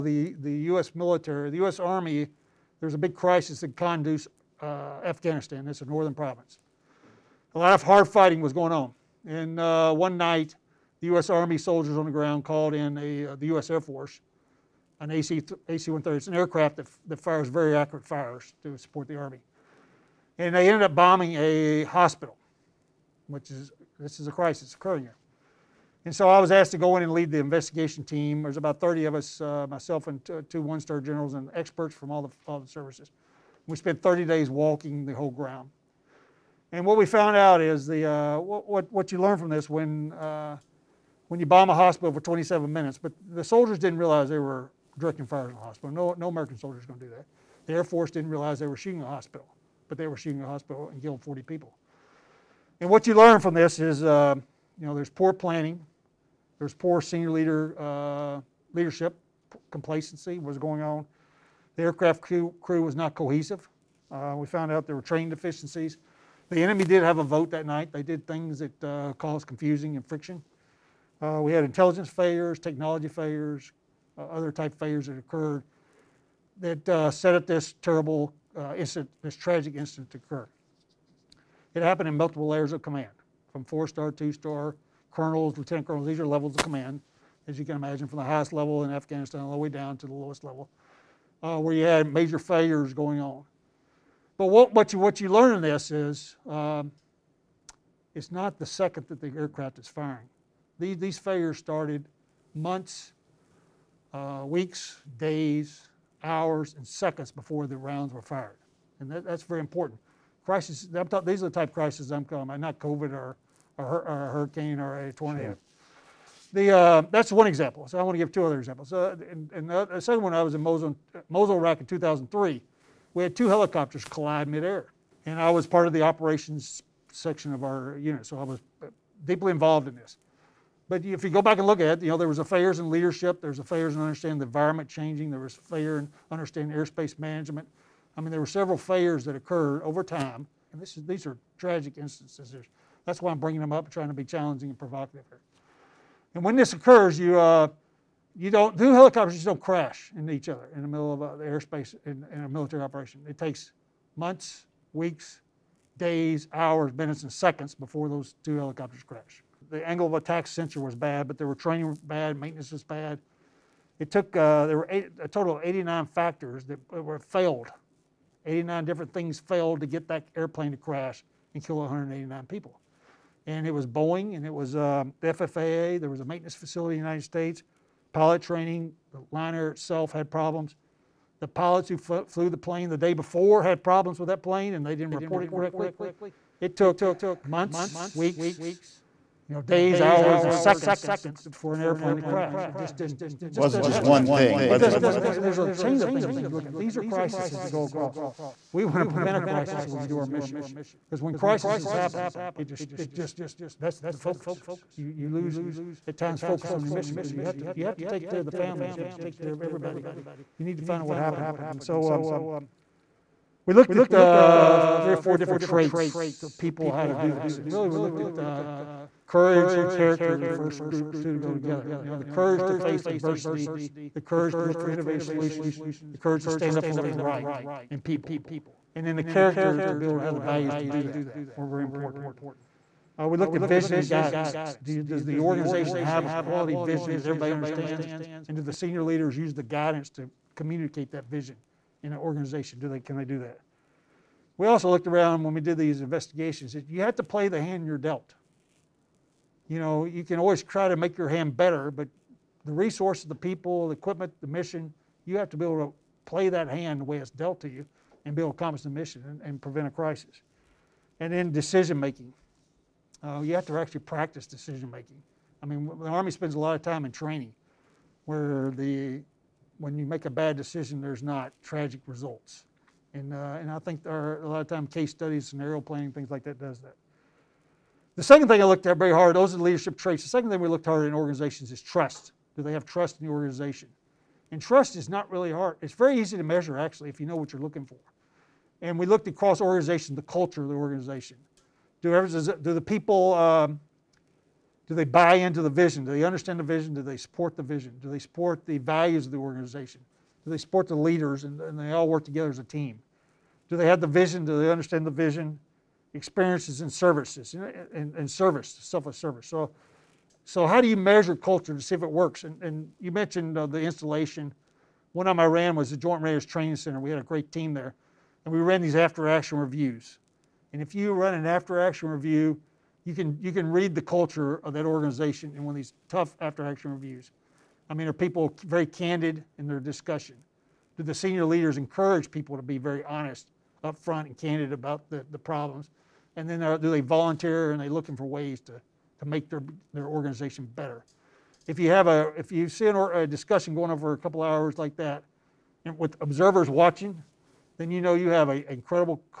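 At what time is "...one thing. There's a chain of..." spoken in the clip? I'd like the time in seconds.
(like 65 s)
195 s.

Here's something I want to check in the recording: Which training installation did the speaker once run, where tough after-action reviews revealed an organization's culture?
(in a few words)
Joint Readiness Training Center.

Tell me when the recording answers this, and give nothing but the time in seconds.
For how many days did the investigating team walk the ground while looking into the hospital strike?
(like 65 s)
34 s.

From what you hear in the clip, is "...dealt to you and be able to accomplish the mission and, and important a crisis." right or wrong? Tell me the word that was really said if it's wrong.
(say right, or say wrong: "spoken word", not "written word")
wrong: "prevent", not "important".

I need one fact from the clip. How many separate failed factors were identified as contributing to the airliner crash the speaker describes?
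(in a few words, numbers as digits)
89.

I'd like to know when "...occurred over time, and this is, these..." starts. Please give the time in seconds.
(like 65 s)
139 s.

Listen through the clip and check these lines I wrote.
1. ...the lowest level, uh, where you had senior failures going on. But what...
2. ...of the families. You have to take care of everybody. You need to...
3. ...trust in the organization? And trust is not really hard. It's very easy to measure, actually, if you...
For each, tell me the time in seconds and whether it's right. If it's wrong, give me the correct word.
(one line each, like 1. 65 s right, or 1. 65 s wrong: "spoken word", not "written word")
1. 90 s wrong: "major", not "senior"
2. 208 s right
3. 282 s right.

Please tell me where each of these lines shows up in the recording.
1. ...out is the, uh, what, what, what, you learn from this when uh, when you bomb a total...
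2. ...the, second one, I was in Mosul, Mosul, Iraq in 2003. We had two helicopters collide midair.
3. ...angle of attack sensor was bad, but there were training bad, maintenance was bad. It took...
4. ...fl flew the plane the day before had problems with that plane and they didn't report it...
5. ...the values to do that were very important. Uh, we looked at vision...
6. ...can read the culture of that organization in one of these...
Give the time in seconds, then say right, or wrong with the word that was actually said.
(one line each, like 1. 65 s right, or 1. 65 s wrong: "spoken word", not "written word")
1. 37 s wrong: "hospital", not "total"
2. 119 s right
3. 159 s right
4. 181 s right
5. 230 s right
6. 323 s right.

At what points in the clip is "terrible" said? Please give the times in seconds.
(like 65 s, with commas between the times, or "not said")
77 s.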